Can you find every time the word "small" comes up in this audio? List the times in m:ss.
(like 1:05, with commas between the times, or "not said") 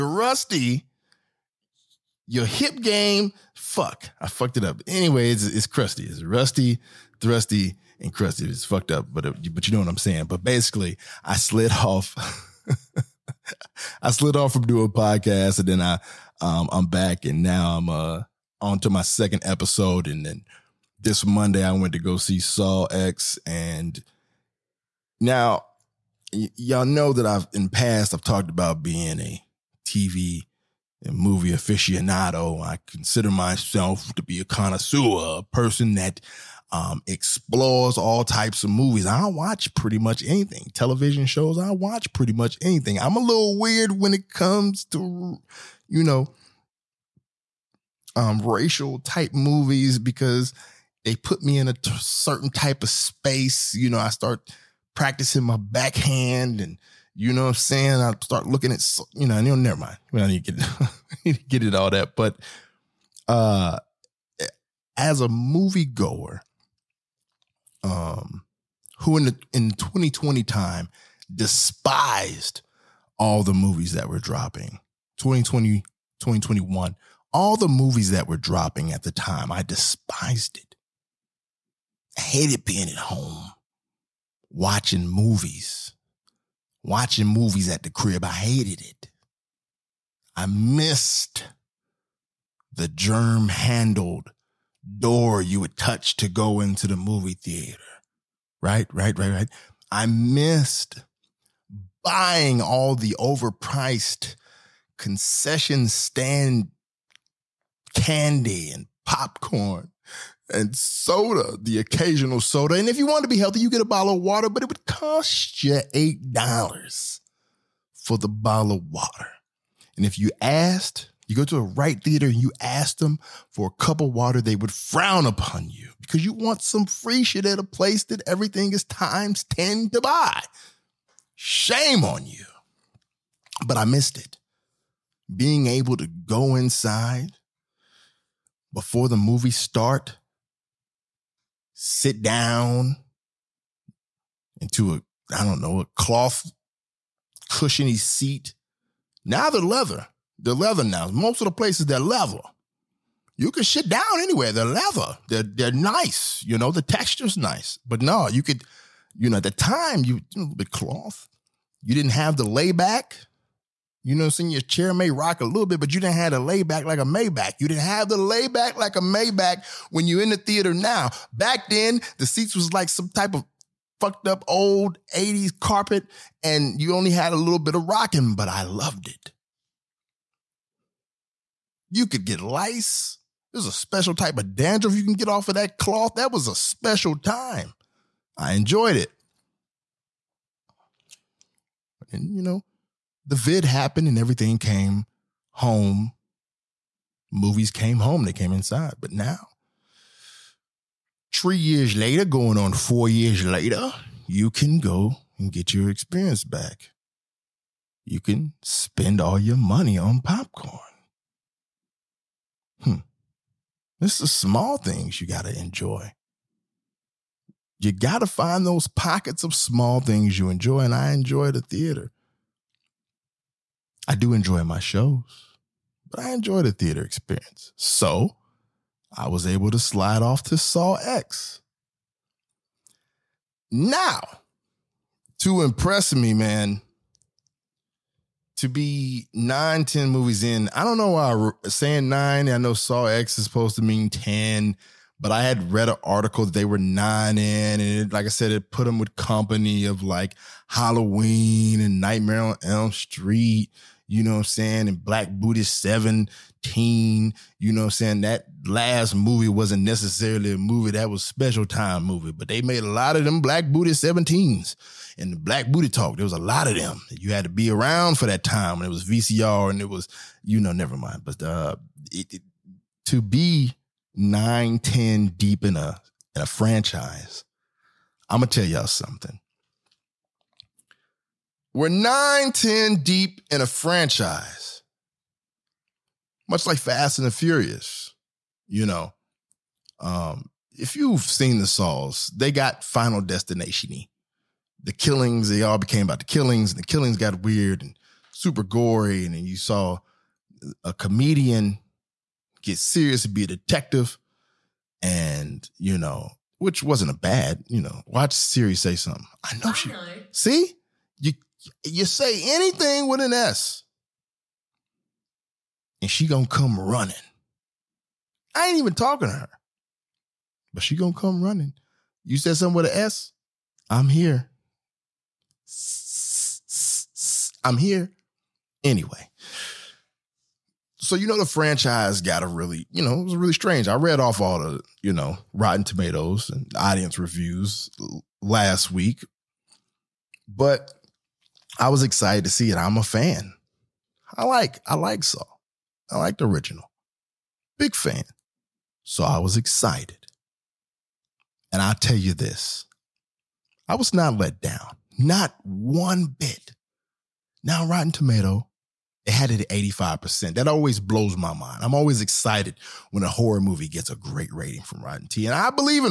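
3:34, 3:39.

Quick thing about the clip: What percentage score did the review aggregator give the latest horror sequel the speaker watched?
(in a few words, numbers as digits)
85%.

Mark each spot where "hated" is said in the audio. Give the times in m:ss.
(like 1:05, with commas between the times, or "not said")
1:22, 1:28.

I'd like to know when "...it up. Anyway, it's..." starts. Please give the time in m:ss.
0:04.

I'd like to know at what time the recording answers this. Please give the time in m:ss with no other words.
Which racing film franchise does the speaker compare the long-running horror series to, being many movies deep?
4:46.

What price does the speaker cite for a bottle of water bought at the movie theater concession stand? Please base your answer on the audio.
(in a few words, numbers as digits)
$8.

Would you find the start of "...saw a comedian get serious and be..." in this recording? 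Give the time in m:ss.
4:59.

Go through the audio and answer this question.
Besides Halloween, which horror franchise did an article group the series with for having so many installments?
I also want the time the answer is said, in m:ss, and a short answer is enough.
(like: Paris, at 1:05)
Nightmare on Elm Street, at 4:12.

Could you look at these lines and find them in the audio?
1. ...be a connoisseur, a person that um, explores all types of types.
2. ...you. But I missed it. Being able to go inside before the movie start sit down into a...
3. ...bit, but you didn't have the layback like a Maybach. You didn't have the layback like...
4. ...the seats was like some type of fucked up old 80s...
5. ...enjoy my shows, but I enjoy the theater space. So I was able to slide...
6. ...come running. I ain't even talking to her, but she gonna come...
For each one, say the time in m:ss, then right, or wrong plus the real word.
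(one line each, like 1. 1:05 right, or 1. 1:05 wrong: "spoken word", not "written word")
1. 0:34 wrong: "movies", not "types"
2. 2:12 right
3. 2:45 right
4. 2:52 right
5. 3:44 wrong: "experience", not "space"
6. 5:16 right.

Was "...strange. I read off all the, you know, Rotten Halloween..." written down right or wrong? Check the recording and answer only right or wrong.
wrong.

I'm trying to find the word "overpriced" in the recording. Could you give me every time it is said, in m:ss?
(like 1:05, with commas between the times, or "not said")
1:43.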